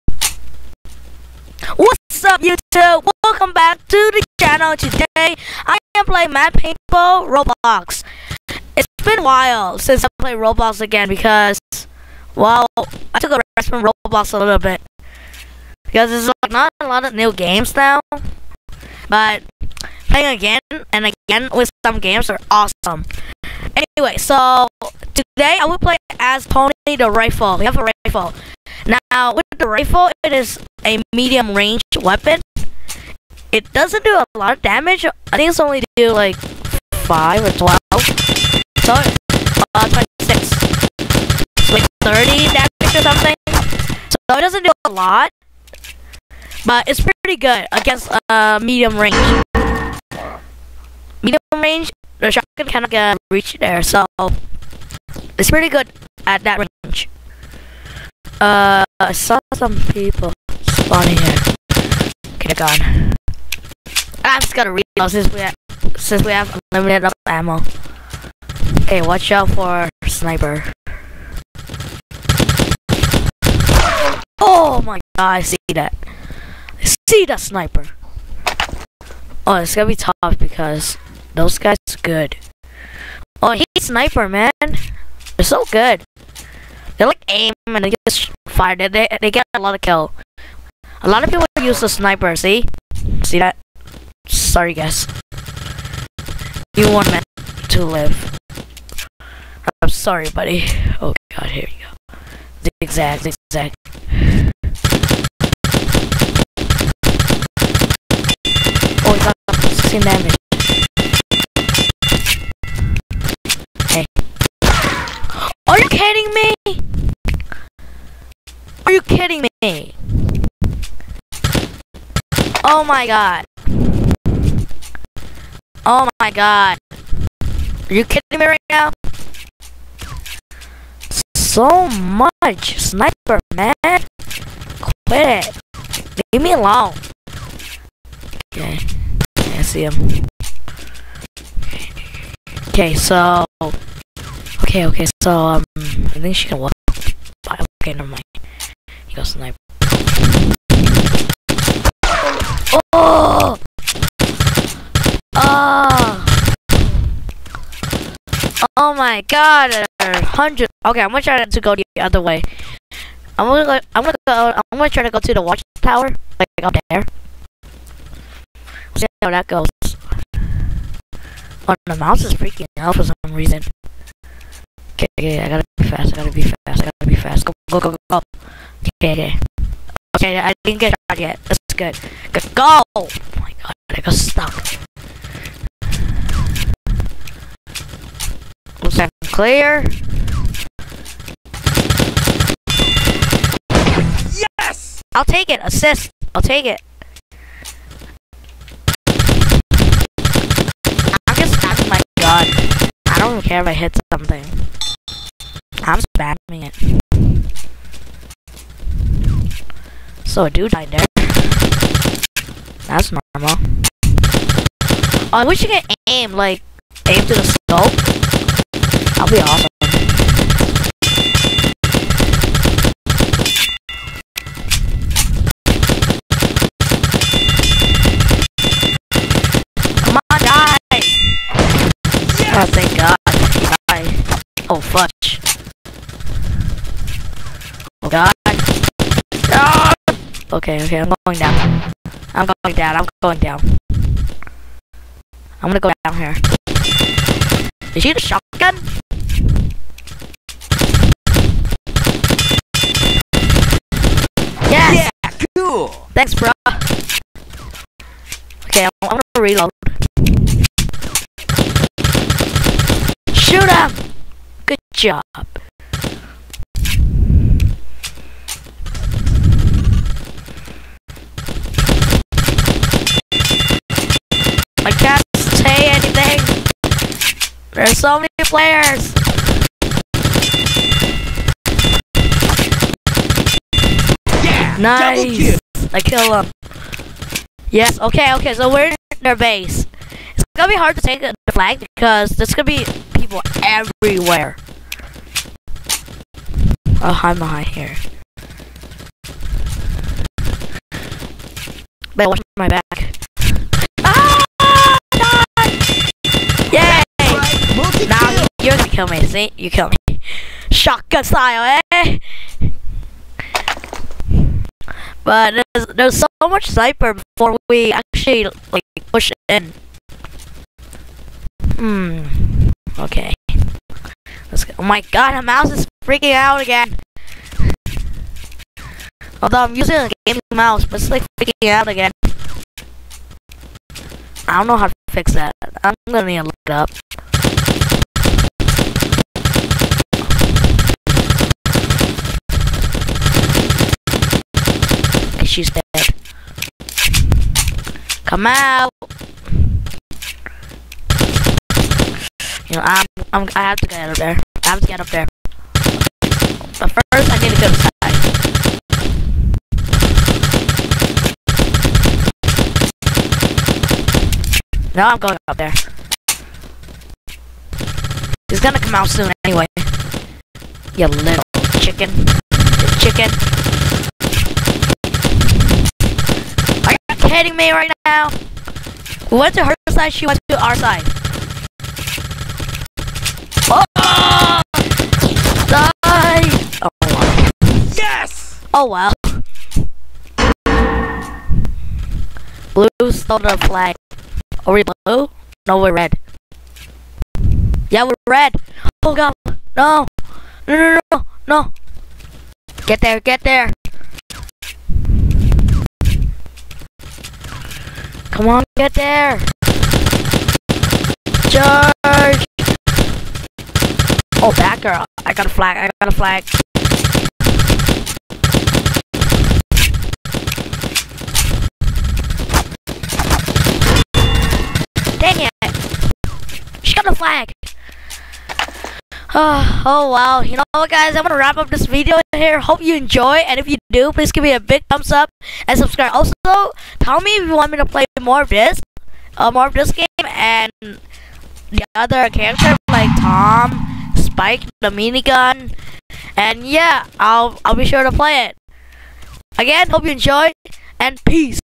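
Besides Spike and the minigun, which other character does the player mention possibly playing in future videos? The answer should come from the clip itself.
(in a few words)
Tom.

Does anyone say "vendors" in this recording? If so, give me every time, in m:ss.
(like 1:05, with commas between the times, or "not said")
not said.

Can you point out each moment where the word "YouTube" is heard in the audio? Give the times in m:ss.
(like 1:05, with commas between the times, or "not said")
0:02.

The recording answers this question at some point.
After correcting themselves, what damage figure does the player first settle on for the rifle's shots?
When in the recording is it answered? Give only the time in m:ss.
0:40.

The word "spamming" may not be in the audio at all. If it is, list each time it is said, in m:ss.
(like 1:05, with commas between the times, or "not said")
3:21, 3:26.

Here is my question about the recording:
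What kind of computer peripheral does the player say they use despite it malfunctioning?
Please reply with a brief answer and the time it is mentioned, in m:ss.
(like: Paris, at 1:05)
gaming mouse, at 5:30.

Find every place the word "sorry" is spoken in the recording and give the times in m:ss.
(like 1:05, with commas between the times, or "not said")
0:38, 1:34, 1:39.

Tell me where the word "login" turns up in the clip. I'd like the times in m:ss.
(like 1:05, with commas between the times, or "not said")
not said.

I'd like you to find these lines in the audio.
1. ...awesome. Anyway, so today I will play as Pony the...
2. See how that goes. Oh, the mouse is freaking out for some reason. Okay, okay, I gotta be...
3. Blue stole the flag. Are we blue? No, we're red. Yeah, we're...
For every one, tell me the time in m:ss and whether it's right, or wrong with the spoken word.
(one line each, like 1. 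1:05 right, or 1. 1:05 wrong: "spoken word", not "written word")
1. 0:22 right
2. 2:48 right
3. 6:32 right.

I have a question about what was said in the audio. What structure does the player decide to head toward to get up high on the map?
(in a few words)
the watchtower.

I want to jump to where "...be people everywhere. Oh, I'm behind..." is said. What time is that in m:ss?
4:52.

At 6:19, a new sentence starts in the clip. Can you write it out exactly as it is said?
We went to her side, she went to our side.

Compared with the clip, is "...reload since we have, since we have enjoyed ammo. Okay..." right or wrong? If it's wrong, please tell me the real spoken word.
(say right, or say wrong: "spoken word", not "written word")
wrong: "unlimited", not "enjoyed".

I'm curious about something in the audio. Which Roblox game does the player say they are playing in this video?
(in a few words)
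Mad Paintball.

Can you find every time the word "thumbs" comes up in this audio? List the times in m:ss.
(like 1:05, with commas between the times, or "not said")
7:14.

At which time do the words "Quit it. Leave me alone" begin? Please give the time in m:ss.
2:14.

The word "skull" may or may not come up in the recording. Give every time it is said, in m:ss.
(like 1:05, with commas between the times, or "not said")
3:37.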